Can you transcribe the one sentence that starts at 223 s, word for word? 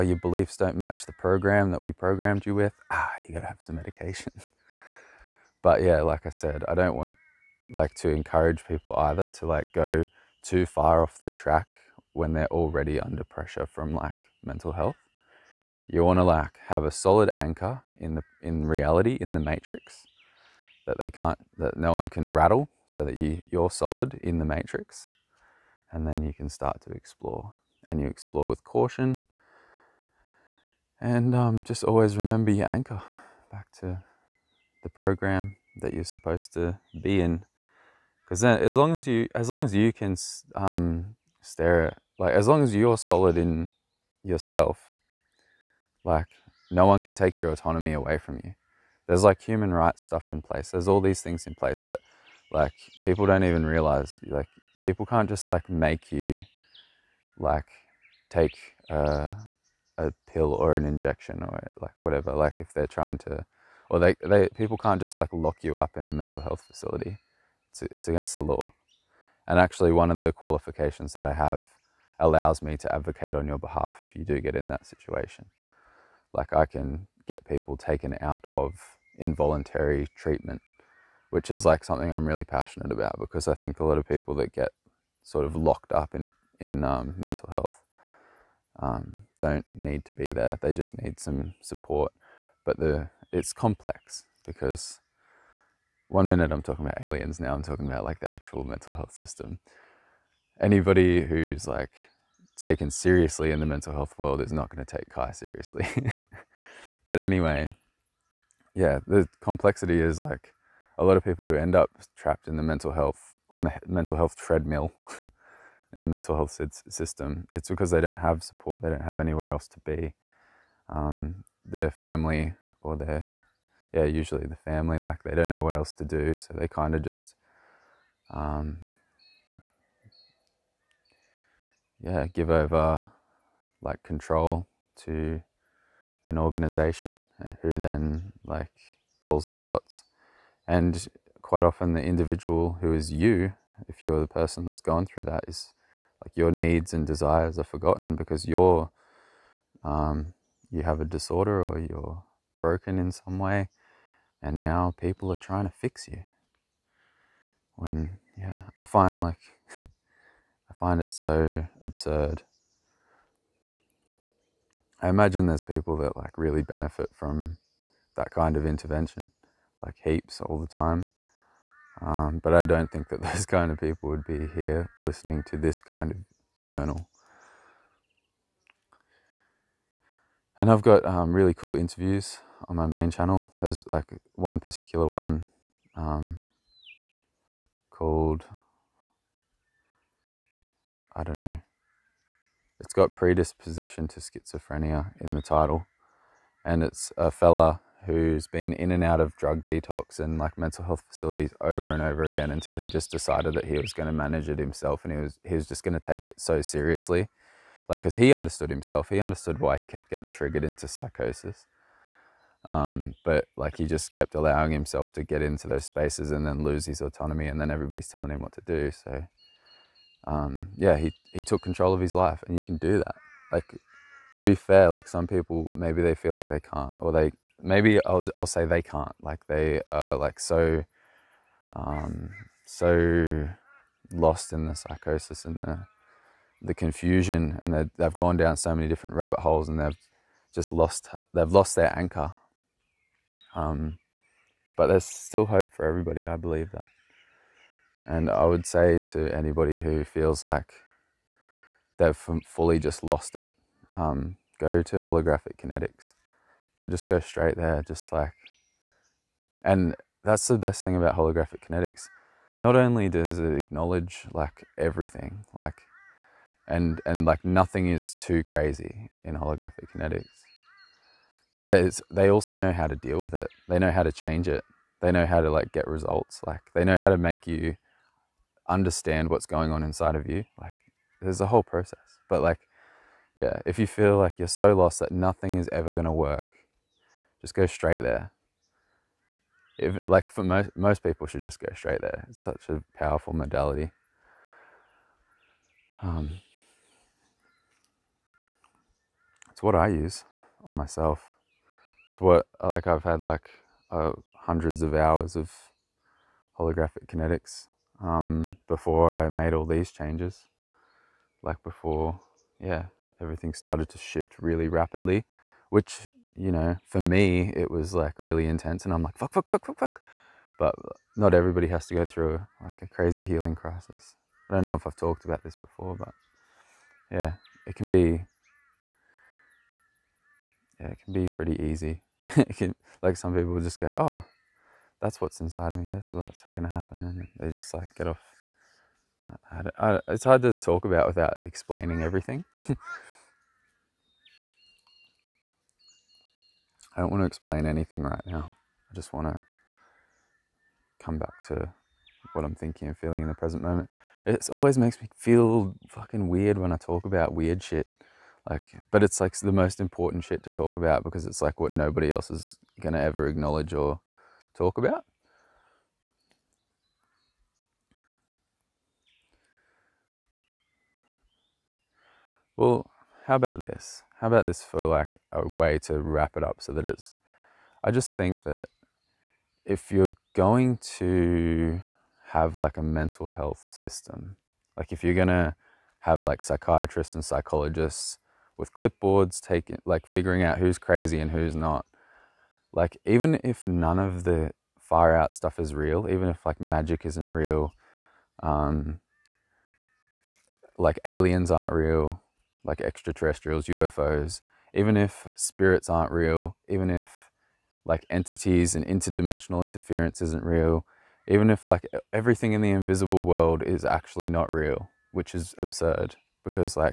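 Like, to be fair, like some people maybe they feel like they can't, or they maybe I'll I'll say they can't.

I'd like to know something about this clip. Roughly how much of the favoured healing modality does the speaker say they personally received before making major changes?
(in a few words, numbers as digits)
hundreds of hours.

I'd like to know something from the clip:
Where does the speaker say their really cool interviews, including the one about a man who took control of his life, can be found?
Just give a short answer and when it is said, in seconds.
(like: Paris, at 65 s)
main channel, at 182 s.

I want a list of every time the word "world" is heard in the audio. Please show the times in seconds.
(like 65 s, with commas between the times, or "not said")
104 s, 413 s.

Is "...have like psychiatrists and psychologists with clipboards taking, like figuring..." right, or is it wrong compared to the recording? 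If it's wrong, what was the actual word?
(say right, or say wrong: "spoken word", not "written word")
right.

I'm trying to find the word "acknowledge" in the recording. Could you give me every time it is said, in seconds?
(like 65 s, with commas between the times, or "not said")
263 s, 363 s.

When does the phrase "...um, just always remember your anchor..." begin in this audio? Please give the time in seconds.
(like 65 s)
31 s.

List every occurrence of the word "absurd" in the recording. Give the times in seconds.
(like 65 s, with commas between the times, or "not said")
161 s, 415 s.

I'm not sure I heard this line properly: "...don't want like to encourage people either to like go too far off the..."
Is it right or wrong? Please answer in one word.
right.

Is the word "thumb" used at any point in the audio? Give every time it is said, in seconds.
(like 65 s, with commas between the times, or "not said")
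not said.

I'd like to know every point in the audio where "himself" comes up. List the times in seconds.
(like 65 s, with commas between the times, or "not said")
204 s, 208 s, 214 s.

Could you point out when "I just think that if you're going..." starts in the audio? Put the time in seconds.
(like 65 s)
377 s.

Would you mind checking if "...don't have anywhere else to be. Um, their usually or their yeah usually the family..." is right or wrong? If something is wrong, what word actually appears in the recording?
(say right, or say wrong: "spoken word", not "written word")
wrong: "family", not "usually".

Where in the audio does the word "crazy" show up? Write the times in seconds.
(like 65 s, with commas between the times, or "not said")
268 s, 322 s, 390 s.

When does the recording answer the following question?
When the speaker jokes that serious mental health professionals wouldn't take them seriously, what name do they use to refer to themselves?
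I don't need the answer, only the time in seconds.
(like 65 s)
105 s.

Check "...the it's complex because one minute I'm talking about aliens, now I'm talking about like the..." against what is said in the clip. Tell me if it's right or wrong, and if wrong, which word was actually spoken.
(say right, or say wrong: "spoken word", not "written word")
right.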